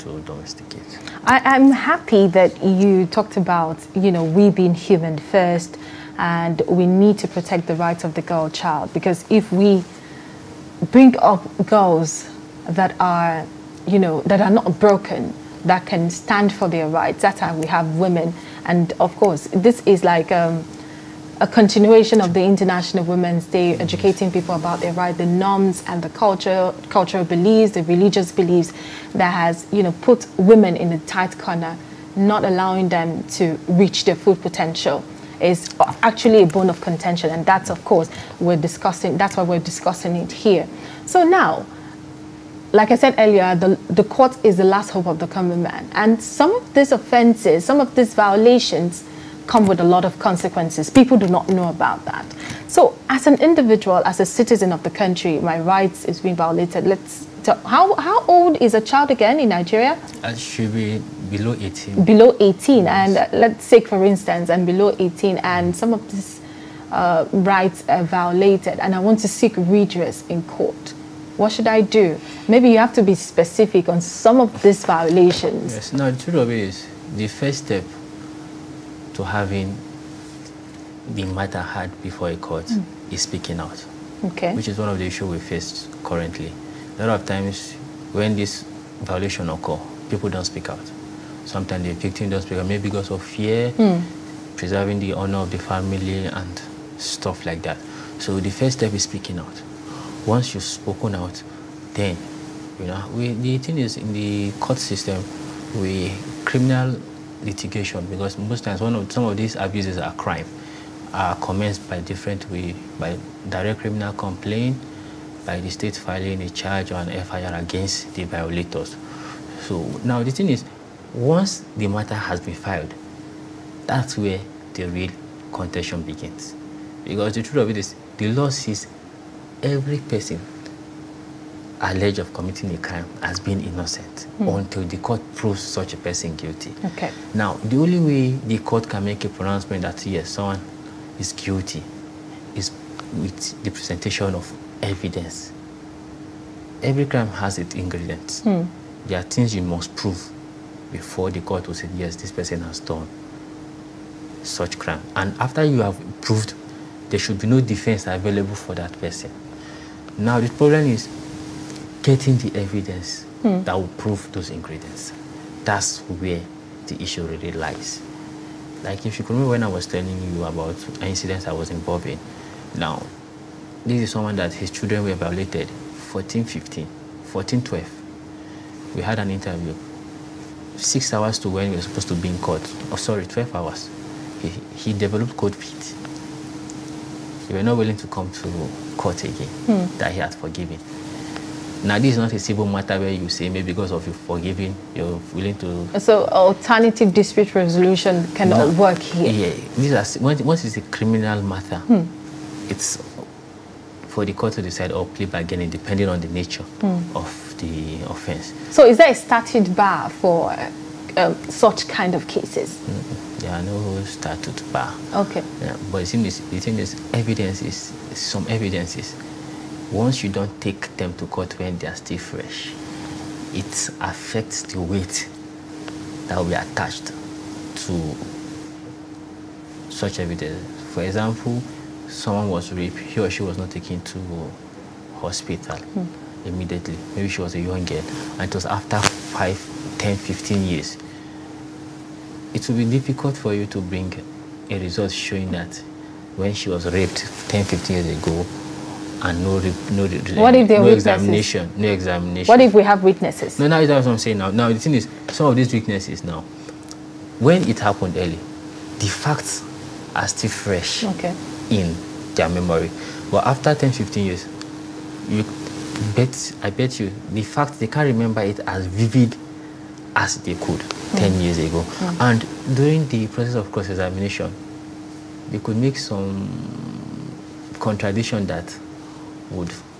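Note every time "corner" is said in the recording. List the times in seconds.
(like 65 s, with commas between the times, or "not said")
31 s.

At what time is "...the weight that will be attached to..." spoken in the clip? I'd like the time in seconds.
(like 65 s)
224 s.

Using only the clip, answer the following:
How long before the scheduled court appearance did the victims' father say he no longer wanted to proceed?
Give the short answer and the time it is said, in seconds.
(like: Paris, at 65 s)
12 hours, at 183 s.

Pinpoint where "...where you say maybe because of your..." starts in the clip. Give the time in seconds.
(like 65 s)
192 s.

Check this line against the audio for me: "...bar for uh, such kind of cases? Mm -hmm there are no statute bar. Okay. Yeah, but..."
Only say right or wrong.
right.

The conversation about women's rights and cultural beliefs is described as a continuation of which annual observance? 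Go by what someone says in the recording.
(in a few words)
International Women's Day.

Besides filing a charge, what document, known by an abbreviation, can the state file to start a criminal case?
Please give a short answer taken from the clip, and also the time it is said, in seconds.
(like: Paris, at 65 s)
FIR, at 117 s.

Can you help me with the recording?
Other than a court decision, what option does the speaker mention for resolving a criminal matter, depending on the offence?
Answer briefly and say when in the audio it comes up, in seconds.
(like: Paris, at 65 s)
Plea bargaining, at 205 s.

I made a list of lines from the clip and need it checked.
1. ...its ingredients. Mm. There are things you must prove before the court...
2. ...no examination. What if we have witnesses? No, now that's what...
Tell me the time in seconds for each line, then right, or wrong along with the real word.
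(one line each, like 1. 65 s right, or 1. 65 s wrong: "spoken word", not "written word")
1. 147 s right
2. 251 s right.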